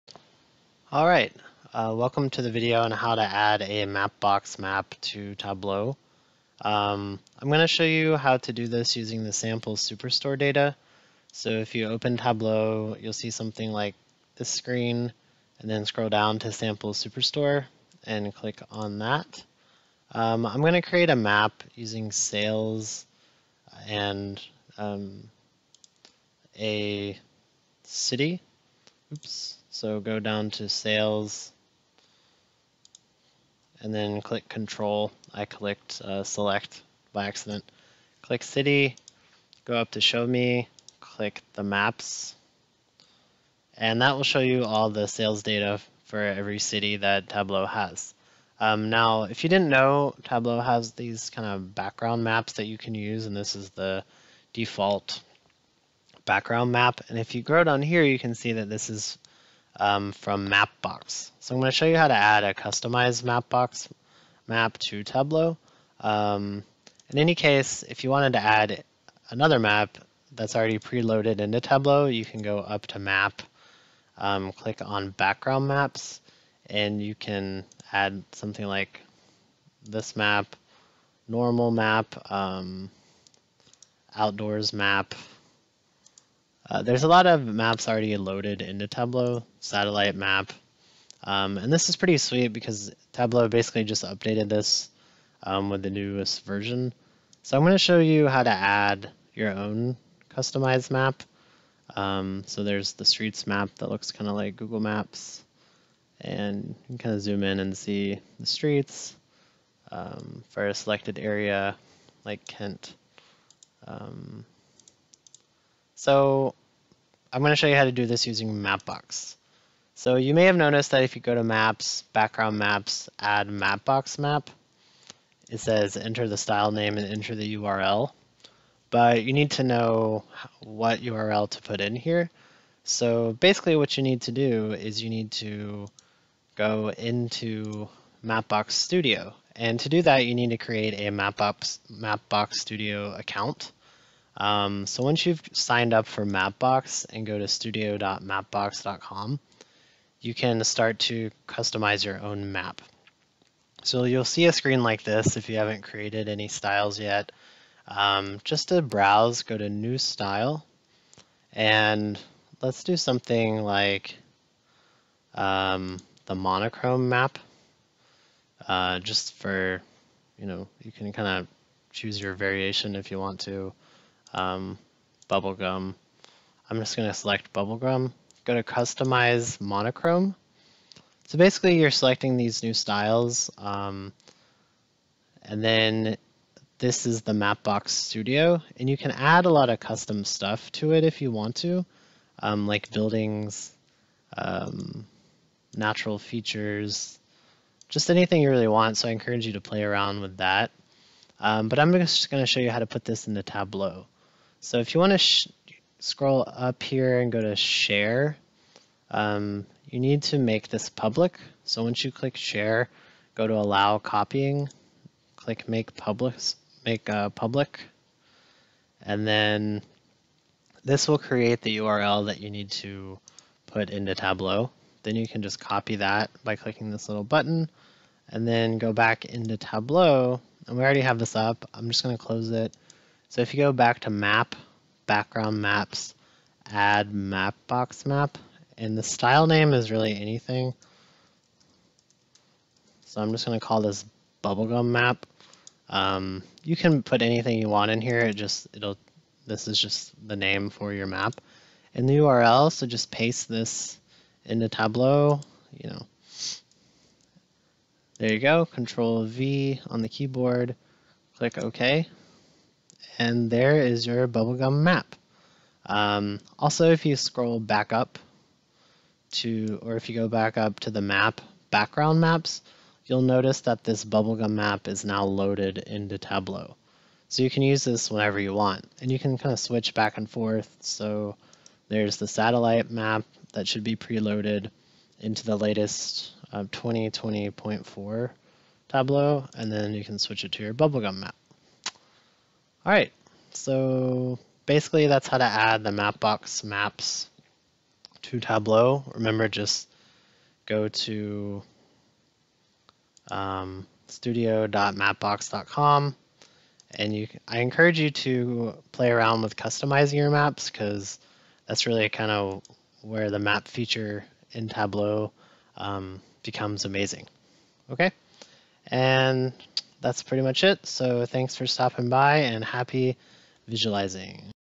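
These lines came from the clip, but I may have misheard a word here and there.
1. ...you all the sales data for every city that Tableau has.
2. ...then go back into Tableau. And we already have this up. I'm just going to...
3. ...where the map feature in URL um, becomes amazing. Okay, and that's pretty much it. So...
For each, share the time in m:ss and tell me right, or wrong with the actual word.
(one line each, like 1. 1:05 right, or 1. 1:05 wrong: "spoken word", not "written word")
1. 0:44 right
2. 3:48 right
3. 5:13 wrong: "Tableau", not "URL".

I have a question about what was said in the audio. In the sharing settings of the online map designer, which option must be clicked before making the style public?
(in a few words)
Allow copying.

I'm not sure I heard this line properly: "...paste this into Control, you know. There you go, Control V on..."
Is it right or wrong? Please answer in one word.
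wrong.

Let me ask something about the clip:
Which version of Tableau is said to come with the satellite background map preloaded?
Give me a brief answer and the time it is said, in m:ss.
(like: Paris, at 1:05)
2020.4, at 4:46.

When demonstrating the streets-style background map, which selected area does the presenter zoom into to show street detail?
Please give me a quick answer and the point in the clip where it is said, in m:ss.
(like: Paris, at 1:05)
Kent, at 1:52.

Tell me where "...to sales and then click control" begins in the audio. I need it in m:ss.
0:30.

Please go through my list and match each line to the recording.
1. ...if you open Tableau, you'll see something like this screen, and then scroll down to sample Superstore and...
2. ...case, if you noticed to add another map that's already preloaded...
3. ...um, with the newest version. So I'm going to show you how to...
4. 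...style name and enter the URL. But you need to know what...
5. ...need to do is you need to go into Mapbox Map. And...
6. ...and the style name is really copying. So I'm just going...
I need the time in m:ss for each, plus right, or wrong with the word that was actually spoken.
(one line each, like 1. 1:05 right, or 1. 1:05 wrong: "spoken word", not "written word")
1. 0:11 right
2. 1:07 wrong: "wanted", not "noticed"
3. 1:35 right
4. 2:06 right
5. 2:14 wrong: "Studio", not "Map"
6. 3:58 wrong: "anything", not "copying".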